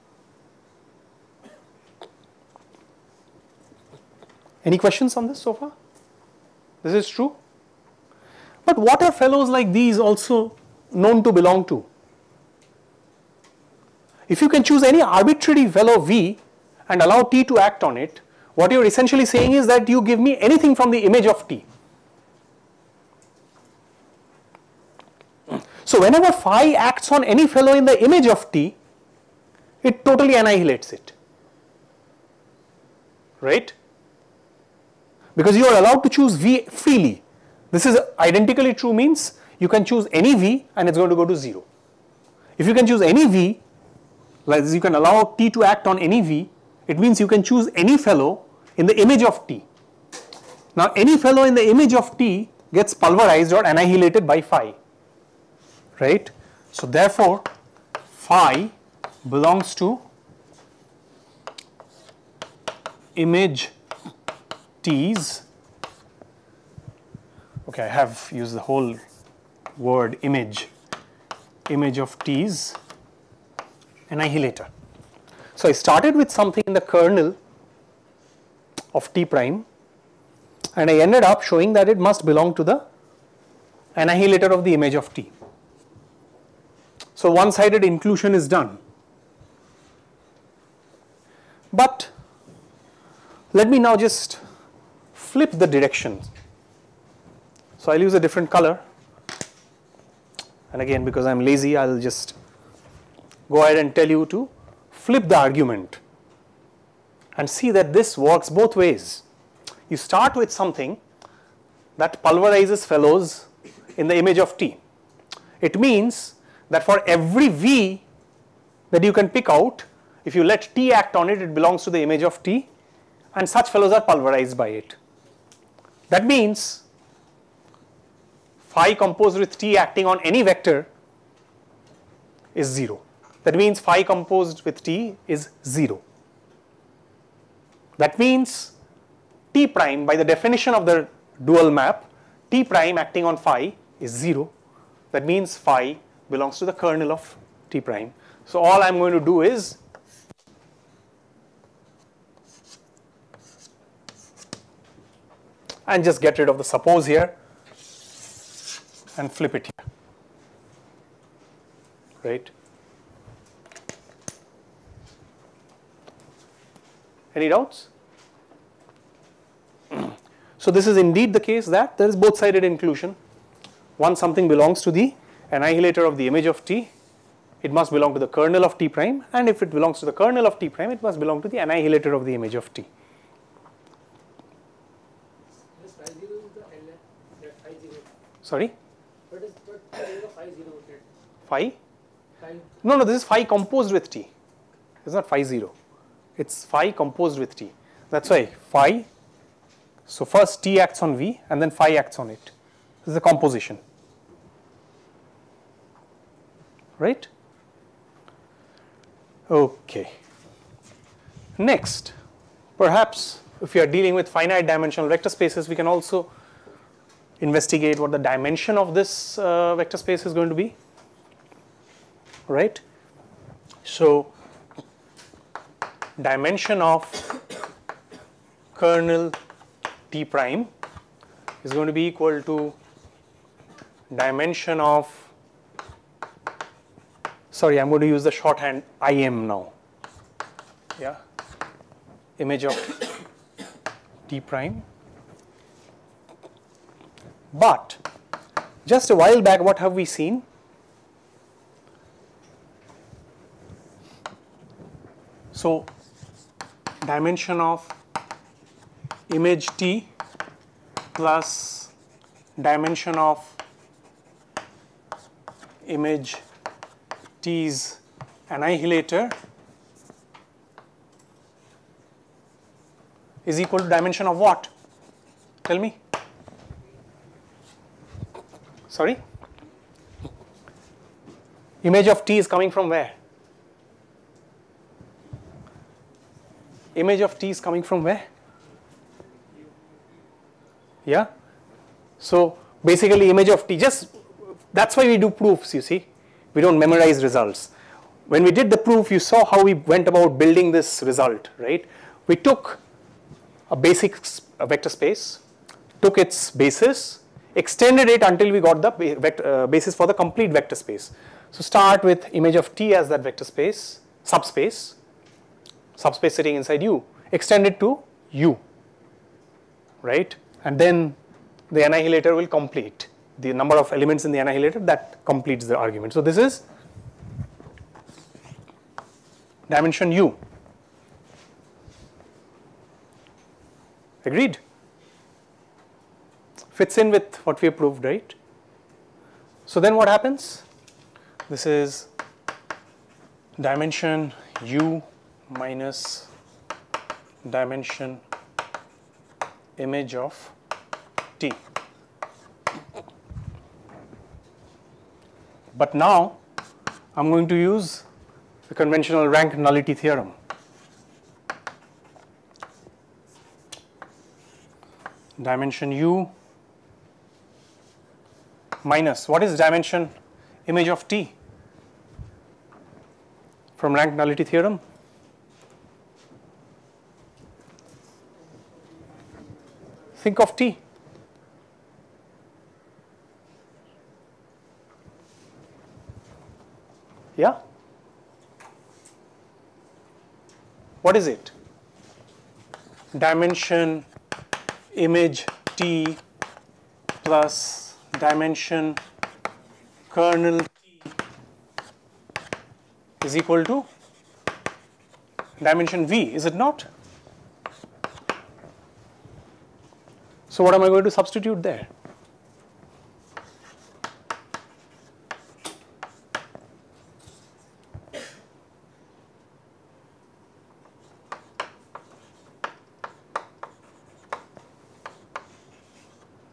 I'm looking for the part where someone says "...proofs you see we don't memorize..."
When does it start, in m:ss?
4:55.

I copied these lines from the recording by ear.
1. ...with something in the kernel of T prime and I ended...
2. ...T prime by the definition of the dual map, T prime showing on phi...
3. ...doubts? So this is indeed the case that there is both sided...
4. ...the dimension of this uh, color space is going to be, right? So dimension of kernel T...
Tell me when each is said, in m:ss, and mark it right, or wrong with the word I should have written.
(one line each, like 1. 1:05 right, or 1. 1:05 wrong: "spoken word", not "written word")
1. 1:16 right
2. 2:19 wrong: "acting", not "showing"
3. 2:47 right
4. 3:38 wrong: "vector", not "color".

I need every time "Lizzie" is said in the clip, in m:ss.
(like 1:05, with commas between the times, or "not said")
not said.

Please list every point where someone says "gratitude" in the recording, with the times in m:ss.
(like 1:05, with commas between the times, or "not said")
not said.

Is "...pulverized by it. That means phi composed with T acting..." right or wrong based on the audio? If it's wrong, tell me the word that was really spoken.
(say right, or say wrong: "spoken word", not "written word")
right.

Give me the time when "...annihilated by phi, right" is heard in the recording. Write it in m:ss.
0:53.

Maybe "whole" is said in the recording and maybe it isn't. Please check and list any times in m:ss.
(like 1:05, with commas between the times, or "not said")
1:08.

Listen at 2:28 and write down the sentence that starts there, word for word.
So all I'm going to do is and just get rid of the suppose here and flip it here, right?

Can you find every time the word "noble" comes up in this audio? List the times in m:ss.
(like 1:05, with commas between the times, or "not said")
not said.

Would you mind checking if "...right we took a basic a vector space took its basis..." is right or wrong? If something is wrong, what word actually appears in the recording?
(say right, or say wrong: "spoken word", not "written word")
right.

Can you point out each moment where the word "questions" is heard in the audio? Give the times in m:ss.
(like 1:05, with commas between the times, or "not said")
0:04.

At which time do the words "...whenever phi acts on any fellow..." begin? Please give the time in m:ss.
0:26.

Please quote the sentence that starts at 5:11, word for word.
So start with image of T as that vector space, subspace, subspace sitting inside U, extend it to U, right?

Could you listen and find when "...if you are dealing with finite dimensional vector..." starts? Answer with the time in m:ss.
3:33.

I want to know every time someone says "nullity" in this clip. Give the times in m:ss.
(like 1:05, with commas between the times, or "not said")
5:59, 6:14.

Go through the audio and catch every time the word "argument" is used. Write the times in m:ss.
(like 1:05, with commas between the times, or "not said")
1:45, 5:25.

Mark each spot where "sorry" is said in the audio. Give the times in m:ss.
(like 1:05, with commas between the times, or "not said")
3:08, 3:57, 4:38.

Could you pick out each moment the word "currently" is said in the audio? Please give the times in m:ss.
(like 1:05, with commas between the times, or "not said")
not said.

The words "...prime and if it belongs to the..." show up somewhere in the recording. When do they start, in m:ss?
2:58.